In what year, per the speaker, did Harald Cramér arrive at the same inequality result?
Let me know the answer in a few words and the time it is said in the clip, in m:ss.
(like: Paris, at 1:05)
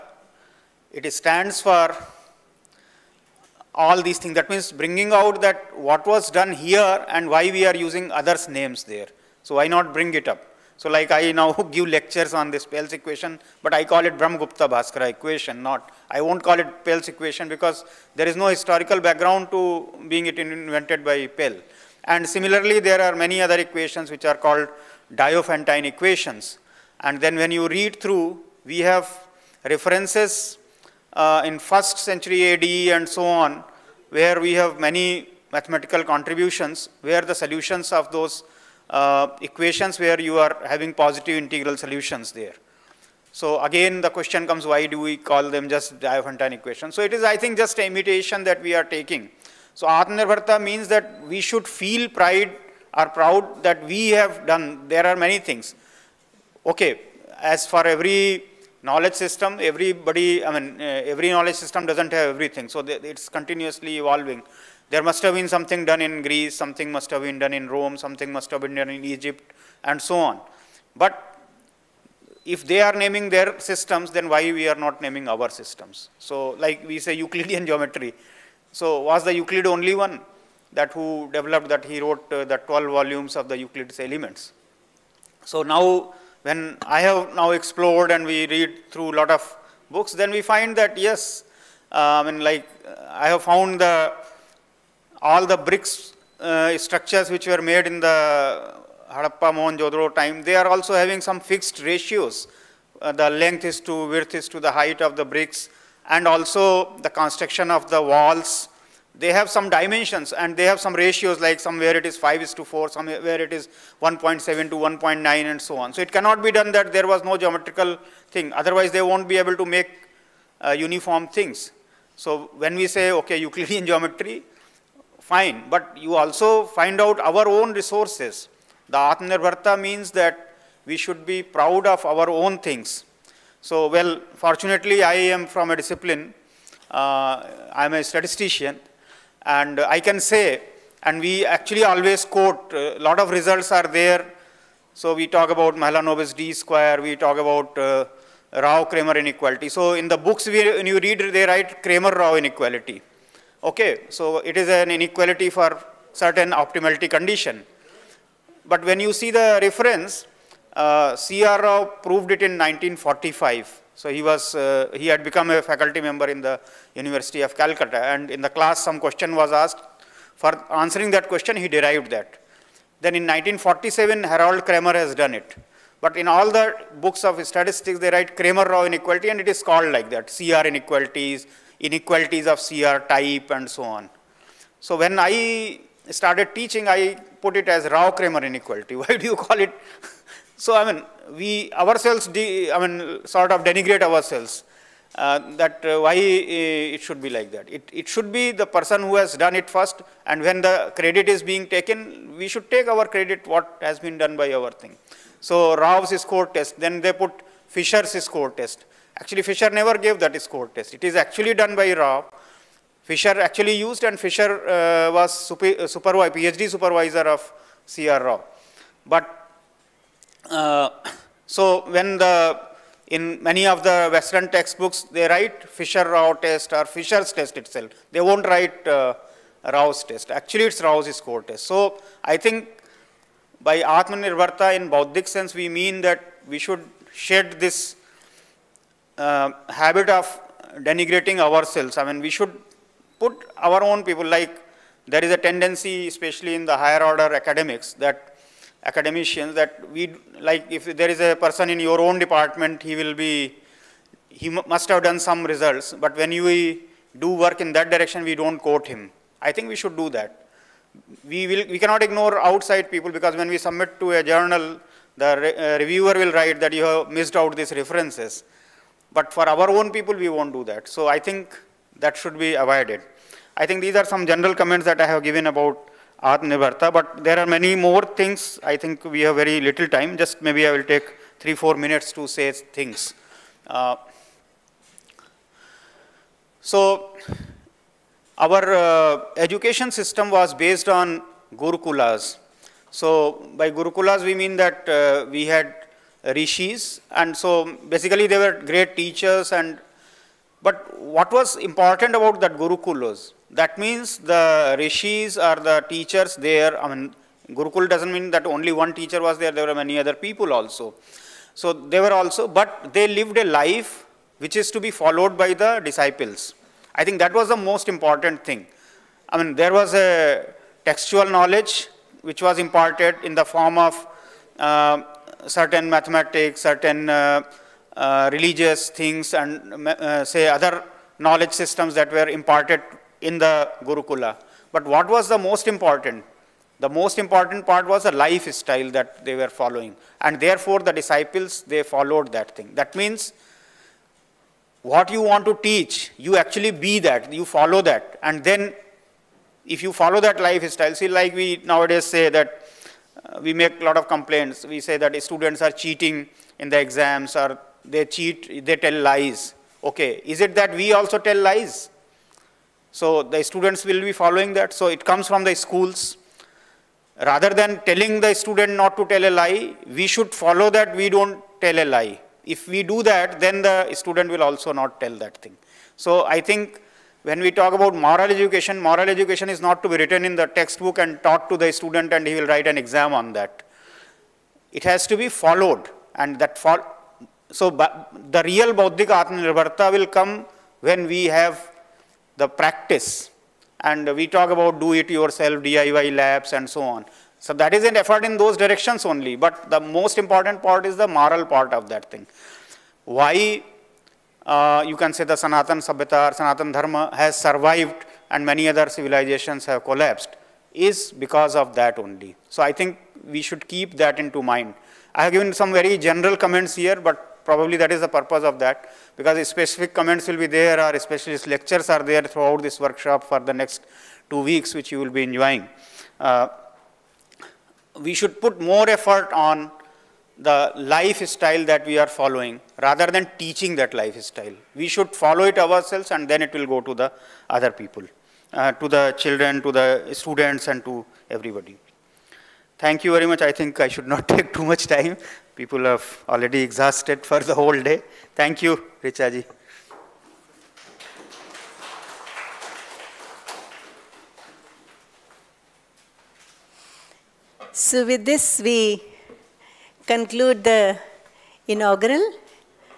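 1947, at 2:53.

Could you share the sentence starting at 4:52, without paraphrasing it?
So by Gurukulas, we mean that uh, we had rishis, and so basically they were great teachers.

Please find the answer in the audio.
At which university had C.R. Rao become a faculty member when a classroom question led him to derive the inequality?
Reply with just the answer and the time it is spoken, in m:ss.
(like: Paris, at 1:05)
University of Calcutta, at 2:46.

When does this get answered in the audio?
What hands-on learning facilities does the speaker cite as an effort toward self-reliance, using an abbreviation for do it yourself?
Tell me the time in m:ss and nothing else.
6:35.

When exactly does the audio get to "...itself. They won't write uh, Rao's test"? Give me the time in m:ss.
3:47.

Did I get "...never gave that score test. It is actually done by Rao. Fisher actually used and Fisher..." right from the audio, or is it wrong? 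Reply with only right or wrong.
right.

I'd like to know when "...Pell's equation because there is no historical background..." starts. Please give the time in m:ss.
0:16.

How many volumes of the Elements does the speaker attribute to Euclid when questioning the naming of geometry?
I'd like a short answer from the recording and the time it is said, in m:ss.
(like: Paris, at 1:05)
12, at 1:22.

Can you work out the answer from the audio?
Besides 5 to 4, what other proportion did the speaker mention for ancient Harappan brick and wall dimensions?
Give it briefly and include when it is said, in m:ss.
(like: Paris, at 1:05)
1.7 to 1.9, at 1:54.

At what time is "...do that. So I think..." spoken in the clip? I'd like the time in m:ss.
4:30.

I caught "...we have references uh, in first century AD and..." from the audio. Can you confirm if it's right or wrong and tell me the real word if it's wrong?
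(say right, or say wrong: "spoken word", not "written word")
right.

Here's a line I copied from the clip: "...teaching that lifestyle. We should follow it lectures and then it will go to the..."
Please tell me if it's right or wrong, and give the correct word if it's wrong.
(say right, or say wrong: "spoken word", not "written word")
wrong: "ourselves", not "lectures".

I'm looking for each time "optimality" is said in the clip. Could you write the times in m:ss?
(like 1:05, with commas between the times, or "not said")
2:36.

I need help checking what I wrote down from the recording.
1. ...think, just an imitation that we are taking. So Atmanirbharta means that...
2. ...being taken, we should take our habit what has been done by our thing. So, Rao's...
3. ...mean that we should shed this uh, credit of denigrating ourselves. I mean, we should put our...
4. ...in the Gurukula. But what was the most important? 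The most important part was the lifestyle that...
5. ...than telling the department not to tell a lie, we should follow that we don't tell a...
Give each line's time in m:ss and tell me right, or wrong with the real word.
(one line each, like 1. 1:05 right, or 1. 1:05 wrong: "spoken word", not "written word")
1. 0:47 right
2. 3:21 wrong: "credit", not "habit"
3. 3:55 wrong: "habit", not "credit"
4. 5:33 right
5. 6:07 wrong: "student", not "department".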